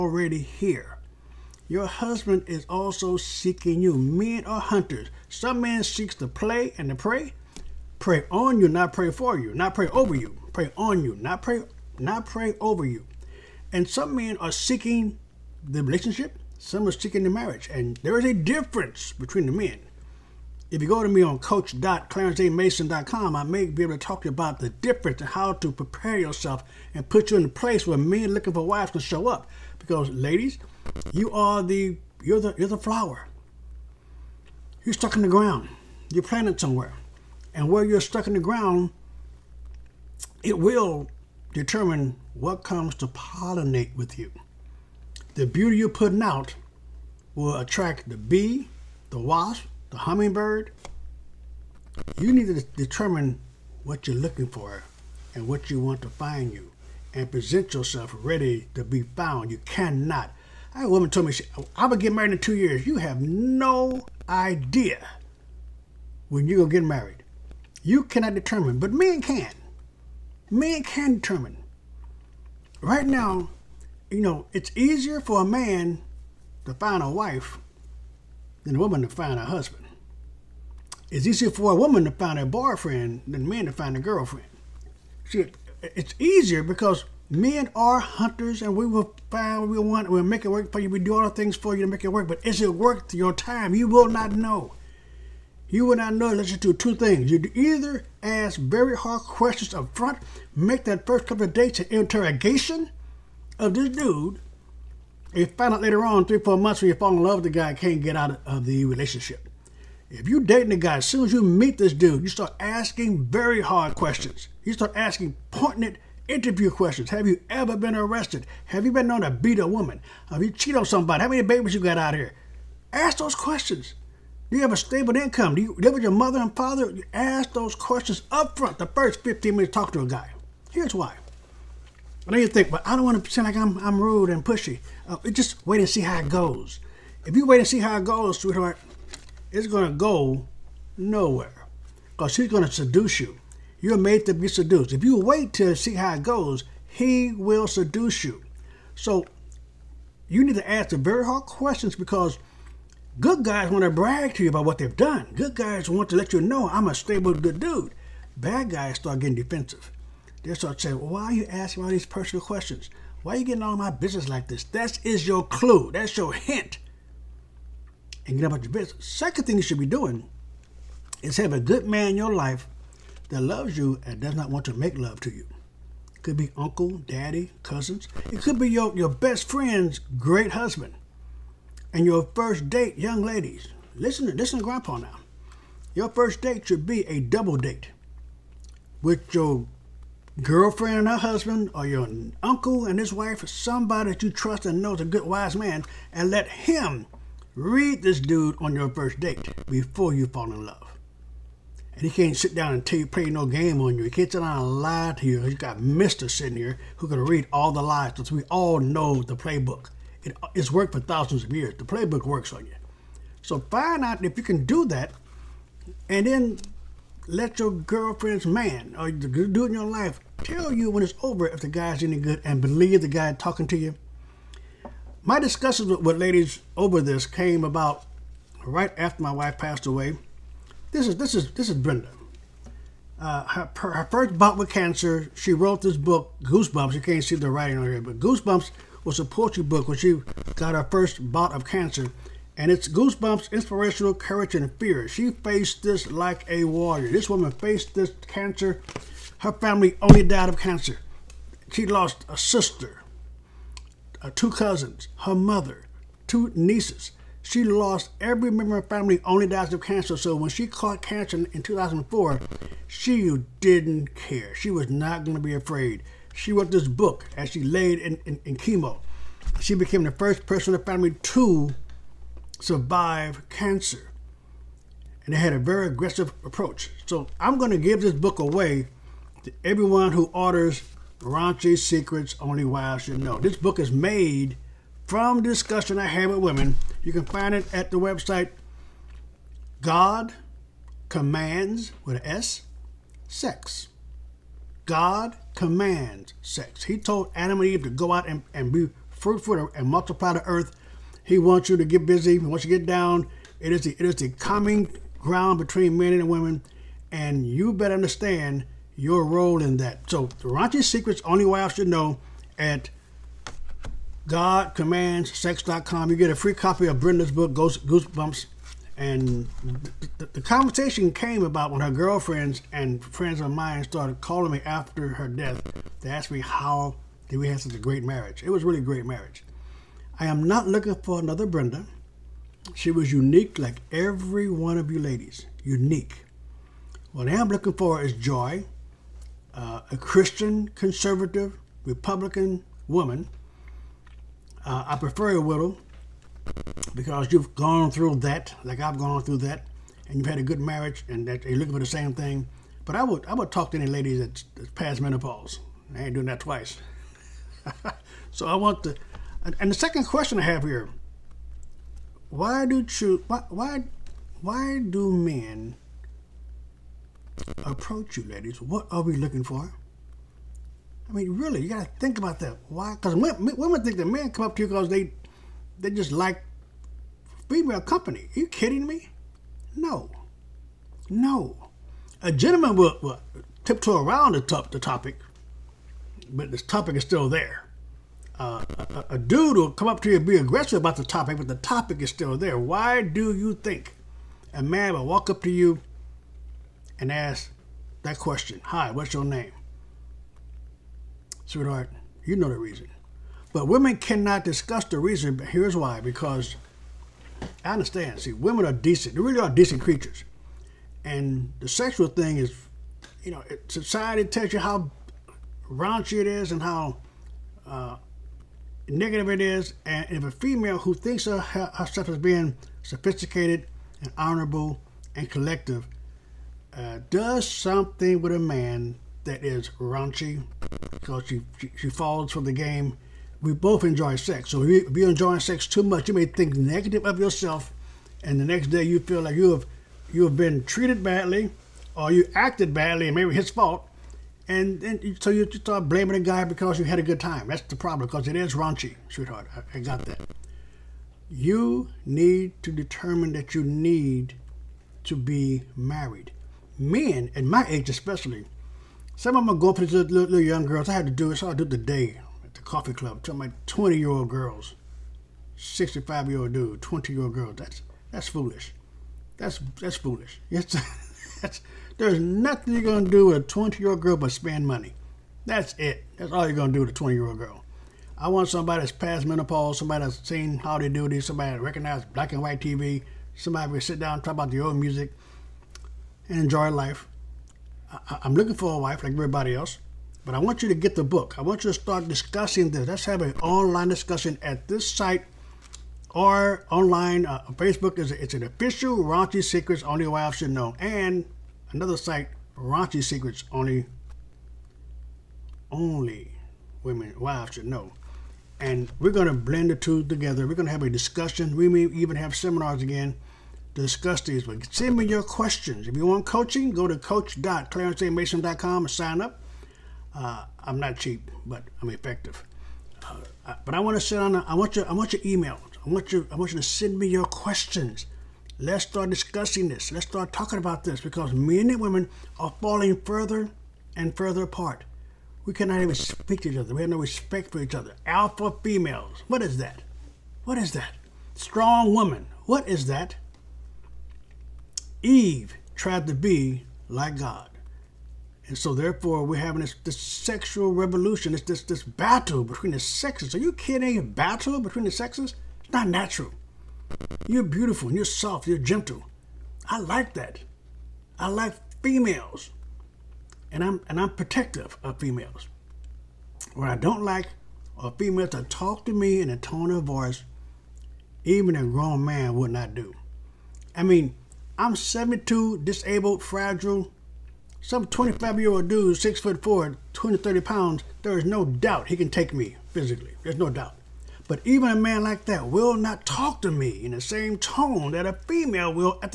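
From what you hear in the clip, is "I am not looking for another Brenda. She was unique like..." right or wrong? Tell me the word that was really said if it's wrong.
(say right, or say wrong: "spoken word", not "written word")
right.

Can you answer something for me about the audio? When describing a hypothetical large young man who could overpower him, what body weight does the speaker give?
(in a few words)
230 pounds.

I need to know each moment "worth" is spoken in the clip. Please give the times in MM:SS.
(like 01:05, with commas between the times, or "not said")
01:32.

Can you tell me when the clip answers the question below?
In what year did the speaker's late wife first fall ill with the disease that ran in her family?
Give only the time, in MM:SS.
04:21.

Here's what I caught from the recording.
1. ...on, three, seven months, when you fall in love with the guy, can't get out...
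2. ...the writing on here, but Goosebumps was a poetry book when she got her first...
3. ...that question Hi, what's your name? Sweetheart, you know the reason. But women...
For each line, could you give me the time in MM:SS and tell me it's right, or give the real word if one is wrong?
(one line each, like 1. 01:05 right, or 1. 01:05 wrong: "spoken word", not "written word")
1. 01:46 wrong: "four", not "seven"
2. 03:57 right
3. 06:38 right.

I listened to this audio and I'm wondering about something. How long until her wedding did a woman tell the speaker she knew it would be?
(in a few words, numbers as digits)
2 years.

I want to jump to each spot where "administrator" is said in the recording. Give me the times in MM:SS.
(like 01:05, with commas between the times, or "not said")
not said.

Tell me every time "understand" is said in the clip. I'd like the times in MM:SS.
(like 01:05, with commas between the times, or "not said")
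05:07, 06:47.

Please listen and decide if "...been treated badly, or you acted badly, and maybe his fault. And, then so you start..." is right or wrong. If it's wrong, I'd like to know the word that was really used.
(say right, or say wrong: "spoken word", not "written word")
right.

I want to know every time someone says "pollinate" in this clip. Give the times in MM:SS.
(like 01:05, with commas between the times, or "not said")
00:43.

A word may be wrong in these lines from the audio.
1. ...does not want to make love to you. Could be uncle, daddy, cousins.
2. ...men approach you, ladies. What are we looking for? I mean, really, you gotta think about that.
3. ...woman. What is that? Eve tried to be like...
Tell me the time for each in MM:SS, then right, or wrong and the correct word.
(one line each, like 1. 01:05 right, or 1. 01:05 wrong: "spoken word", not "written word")
1. 02:54 right
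2. 06:05 right
3. 09:01 right.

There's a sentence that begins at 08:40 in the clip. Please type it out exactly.
Uh, I'm not cheap, but I'm effective.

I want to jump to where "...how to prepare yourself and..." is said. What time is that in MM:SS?
00:25.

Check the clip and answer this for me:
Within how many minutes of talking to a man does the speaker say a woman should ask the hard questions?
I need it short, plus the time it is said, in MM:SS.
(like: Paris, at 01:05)
15, at 02:08.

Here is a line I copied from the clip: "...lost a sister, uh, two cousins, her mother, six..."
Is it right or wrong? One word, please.
wrong.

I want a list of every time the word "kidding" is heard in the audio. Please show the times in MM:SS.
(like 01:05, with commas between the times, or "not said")
06:18, 09:13.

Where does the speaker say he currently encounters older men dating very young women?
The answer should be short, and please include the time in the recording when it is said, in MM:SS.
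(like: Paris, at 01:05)
the coffee club, at 07:42.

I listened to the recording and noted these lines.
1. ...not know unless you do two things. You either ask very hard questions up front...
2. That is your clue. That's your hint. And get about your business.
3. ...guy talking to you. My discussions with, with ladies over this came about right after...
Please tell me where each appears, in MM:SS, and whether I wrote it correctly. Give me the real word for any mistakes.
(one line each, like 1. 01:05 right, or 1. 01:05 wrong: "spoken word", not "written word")
1. 01:35 right
2. 02:44 right
3. 03:43 right.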